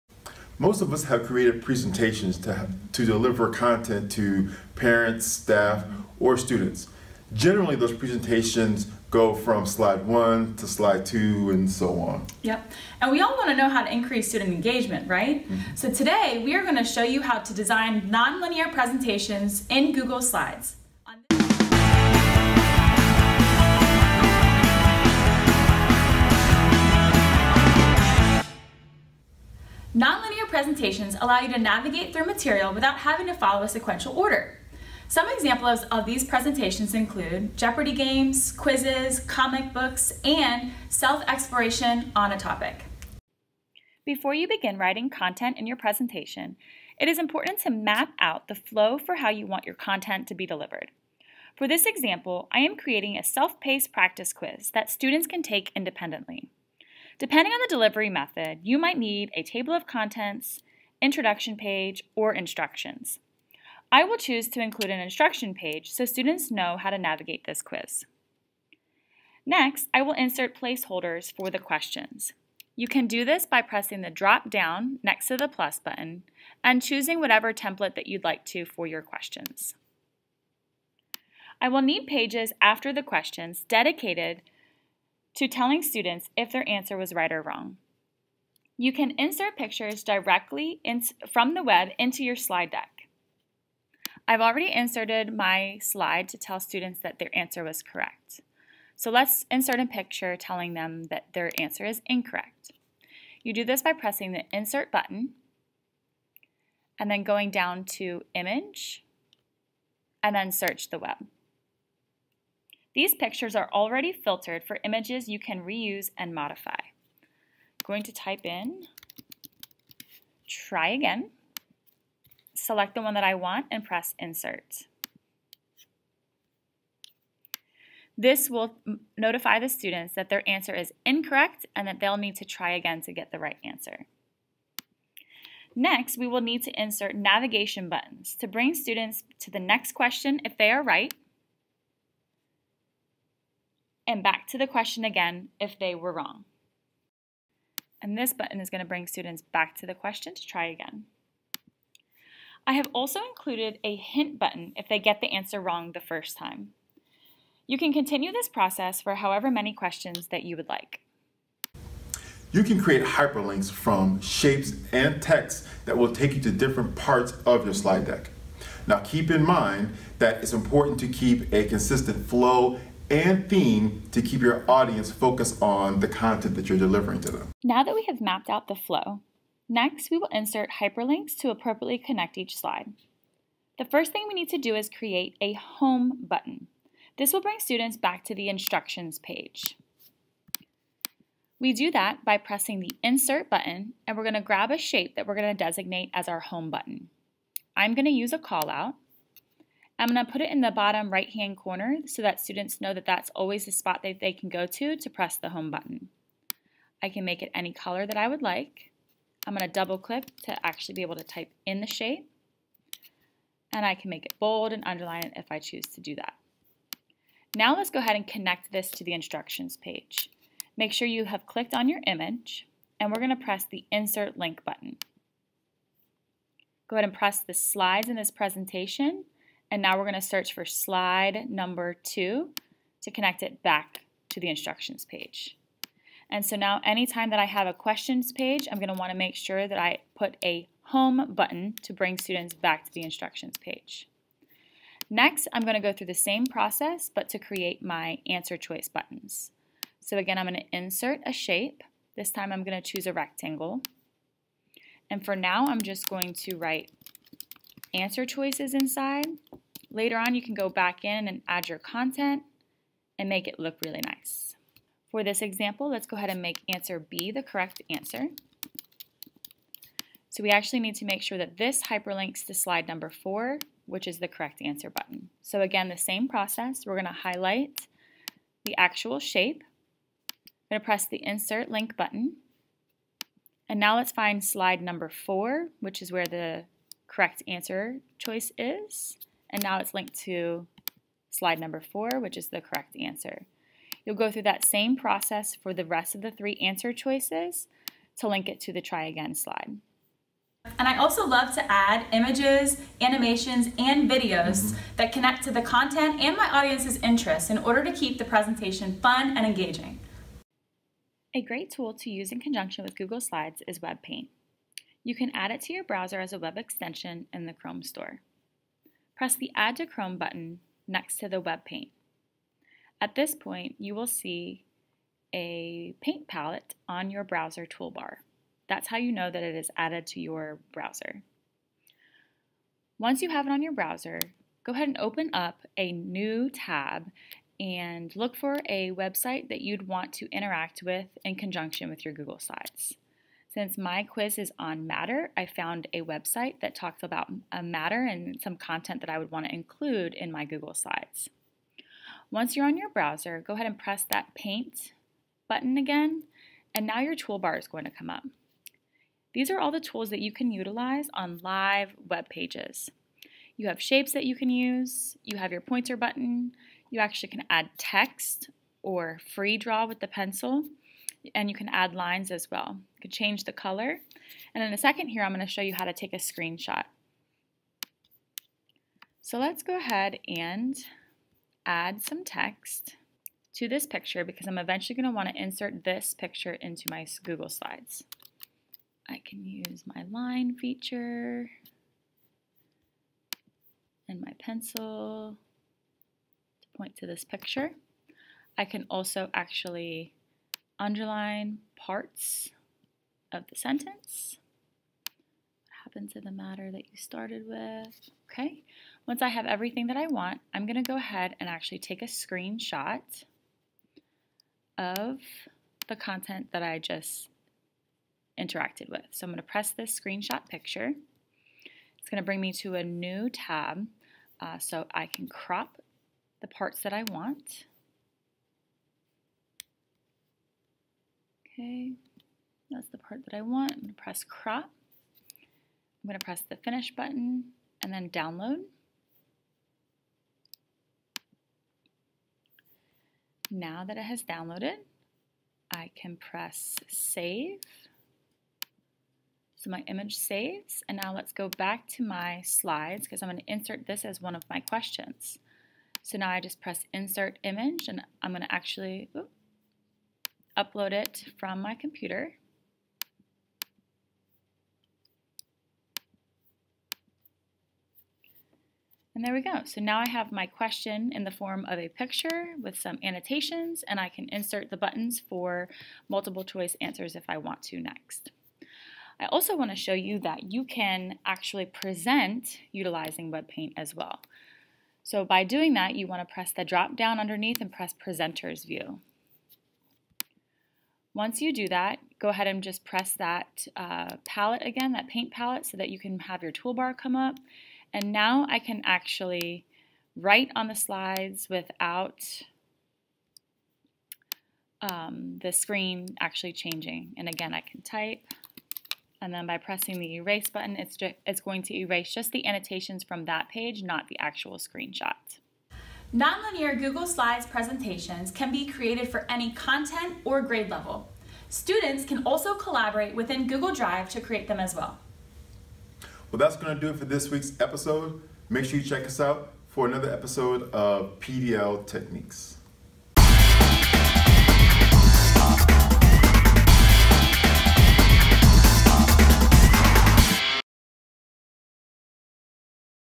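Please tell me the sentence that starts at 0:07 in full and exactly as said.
Generally, those presentations go from slide one to slide two and so on.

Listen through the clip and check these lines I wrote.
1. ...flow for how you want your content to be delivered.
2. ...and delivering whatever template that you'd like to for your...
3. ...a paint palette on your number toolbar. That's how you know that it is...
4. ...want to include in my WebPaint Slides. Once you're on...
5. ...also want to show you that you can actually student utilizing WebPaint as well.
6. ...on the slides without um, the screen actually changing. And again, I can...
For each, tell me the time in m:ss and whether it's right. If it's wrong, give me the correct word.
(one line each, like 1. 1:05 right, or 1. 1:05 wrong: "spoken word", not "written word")
1. 0:48 right
2. 1:16 wrong: "choosing", not "delivering"
3. 5:25 wrong: "browser", not "number"
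4. 5:49 wrong: "Google", not "WebPaint"
5. 7:59 wrong: "present", not "student"
6. 8:20 right.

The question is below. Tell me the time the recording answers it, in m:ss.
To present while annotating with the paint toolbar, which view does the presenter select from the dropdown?
8:07.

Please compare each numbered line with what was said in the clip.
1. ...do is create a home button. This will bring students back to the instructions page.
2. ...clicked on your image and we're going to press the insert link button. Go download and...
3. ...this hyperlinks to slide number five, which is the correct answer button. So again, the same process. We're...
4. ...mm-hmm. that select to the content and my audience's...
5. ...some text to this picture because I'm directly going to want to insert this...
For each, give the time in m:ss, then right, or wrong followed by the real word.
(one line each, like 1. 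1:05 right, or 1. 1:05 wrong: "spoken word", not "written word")
1. 3:04 right
2. 3:41 wrong: "ahead", not "download"
3. 4:31 wrong: "four", not "five"
4. 5:04 wrong: "connect", not "select"
5. 6:22 wrong: "eventually", not "directly".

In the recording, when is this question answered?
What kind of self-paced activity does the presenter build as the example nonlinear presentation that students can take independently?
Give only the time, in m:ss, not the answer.
0:53.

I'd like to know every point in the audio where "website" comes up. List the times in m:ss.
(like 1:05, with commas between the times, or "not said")
5:38, 5:46.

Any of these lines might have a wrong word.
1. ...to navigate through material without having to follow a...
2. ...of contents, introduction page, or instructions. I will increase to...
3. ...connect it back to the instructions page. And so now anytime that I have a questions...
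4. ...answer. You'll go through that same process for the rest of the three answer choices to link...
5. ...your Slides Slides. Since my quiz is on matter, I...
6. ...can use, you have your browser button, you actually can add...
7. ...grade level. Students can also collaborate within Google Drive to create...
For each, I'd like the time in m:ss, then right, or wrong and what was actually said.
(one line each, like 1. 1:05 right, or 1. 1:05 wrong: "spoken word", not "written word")
1. 0:31 right
2. 0:59 wrong: "choose", not "increase"
3. 3:53 right
4. 4:52 right
5. 5:42 wrong: "Google", not "Slides"
6. 6:04 wrong: "pointer", not "browser"
7. 8:40 right.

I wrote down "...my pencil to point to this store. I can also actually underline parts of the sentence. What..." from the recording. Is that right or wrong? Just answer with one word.
wrong.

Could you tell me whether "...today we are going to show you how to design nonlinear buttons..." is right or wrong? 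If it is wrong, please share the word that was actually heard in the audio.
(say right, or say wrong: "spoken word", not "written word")
wrong: "presentations", not "buttons".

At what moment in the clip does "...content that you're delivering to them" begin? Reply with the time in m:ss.
2:56.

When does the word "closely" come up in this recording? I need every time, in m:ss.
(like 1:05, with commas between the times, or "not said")
not said.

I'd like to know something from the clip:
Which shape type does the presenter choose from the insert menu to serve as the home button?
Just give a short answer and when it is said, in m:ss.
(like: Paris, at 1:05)
callout, at 3:18.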